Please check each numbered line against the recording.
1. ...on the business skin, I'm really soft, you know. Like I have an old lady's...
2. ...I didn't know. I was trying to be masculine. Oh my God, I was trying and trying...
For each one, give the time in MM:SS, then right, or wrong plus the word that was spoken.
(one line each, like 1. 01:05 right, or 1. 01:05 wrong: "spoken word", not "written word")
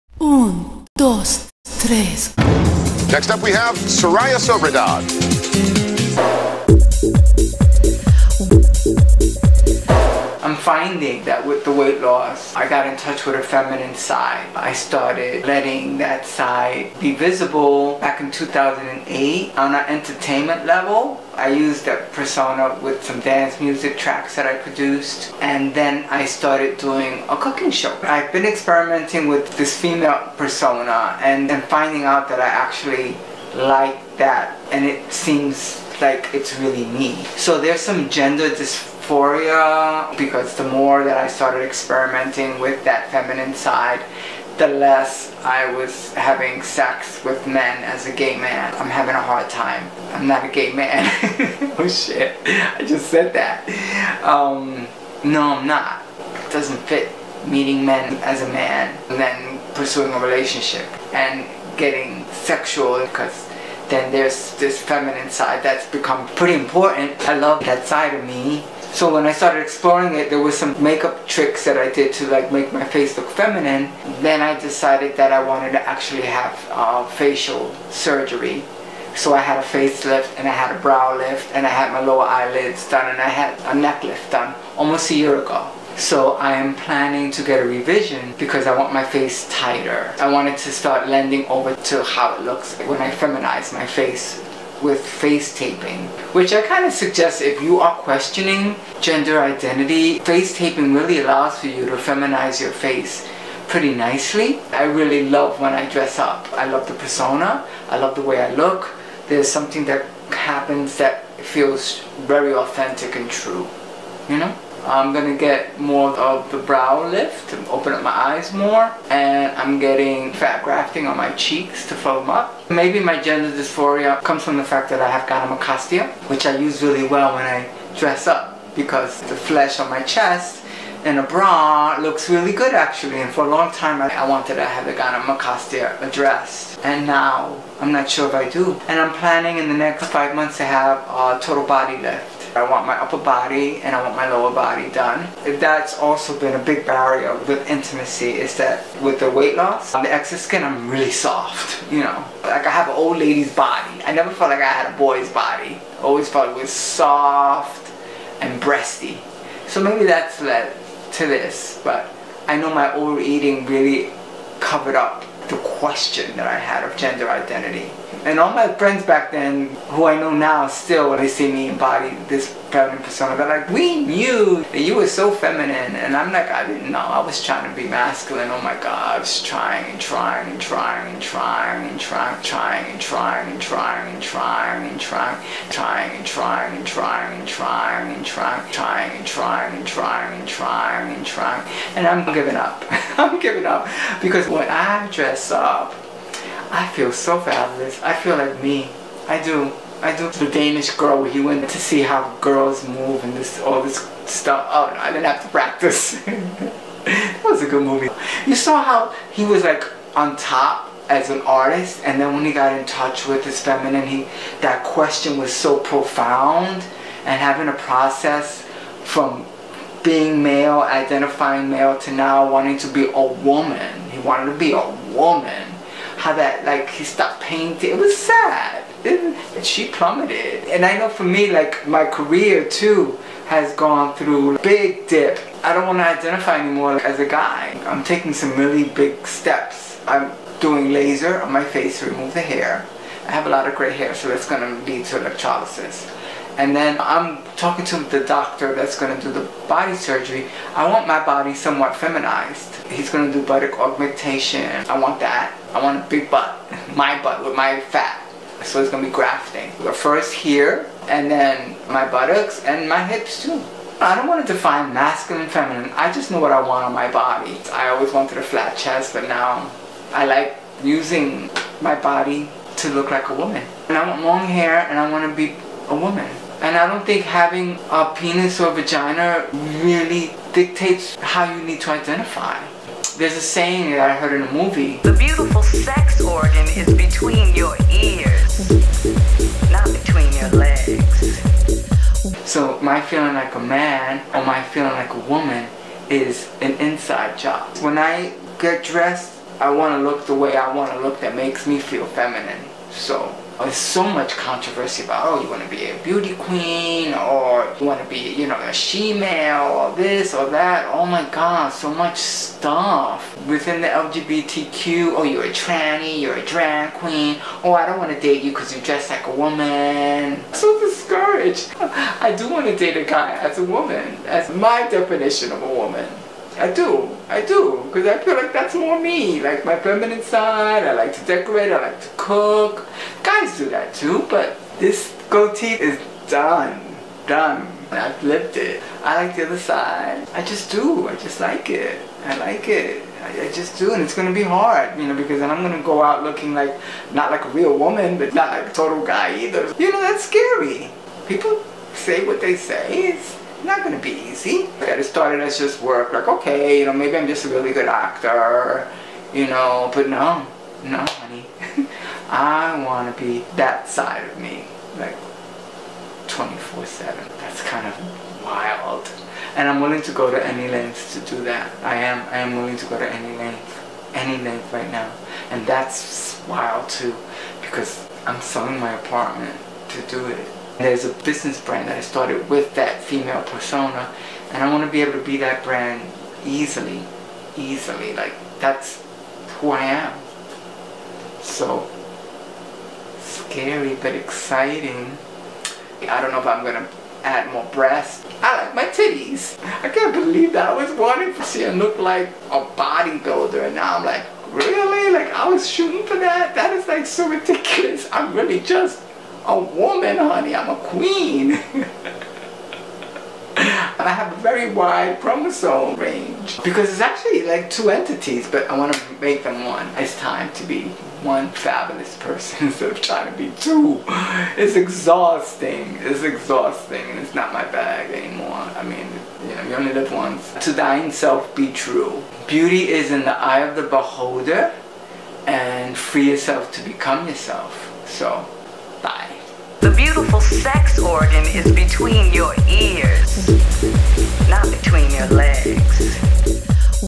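1. 02:29 wrong: "excess", not "business"
2. 02:56 right.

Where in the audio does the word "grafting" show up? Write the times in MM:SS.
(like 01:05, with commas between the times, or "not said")
02:00, 04:19.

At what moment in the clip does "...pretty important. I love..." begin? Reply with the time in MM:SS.
01:06.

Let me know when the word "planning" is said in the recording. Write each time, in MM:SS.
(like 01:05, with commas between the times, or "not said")
01:26, 02:19.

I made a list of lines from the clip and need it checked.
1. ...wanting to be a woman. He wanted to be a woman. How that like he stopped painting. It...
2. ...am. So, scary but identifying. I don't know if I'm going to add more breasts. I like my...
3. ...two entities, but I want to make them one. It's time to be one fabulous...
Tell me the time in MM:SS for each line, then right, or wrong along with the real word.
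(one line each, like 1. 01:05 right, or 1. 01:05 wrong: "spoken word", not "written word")
1. 03:42 right
2. 06:29 wrong: "exciting", not "identifying"
3. 06:57 right.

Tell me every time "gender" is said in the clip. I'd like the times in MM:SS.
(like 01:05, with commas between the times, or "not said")
00:38, 01:38, 02:03, 02:46.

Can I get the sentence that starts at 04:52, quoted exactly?
So my feeling like a man or my feeling like a woman is an inside job.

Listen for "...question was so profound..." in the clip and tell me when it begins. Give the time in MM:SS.
03:34.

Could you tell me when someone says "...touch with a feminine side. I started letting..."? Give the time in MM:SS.
00:12.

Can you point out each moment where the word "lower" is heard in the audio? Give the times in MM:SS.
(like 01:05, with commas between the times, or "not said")
01:22, 02:24.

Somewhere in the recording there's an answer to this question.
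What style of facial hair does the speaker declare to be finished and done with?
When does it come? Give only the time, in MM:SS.
05:35.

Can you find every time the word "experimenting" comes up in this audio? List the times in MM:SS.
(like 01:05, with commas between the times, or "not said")
00:28, 00:41.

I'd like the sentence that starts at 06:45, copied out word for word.
Like, I was shooting for that?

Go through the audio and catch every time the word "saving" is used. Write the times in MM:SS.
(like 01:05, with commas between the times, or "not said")
not said.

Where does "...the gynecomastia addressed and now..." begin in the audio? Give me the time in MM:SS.
02:14.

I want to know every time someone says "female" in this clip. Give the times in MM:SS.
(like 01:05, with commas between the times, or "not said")
00:29, 06:23.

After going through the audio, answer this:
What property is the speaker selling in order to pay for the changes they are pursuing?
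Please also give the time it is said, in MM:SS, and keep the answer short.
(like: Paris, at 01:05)
apartment, at 06:18.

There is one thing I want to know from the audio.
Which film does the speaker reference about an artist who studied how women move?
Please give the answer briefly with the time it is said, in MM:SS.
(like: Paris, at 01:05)
The Danish Girl, at 03:20.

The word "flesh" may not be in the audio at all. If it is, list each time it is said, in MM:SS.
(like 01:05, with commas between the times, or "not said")
02:09.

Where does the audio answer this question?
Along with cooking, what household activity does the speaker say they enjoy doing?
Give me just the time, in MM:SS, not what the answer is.
05:31.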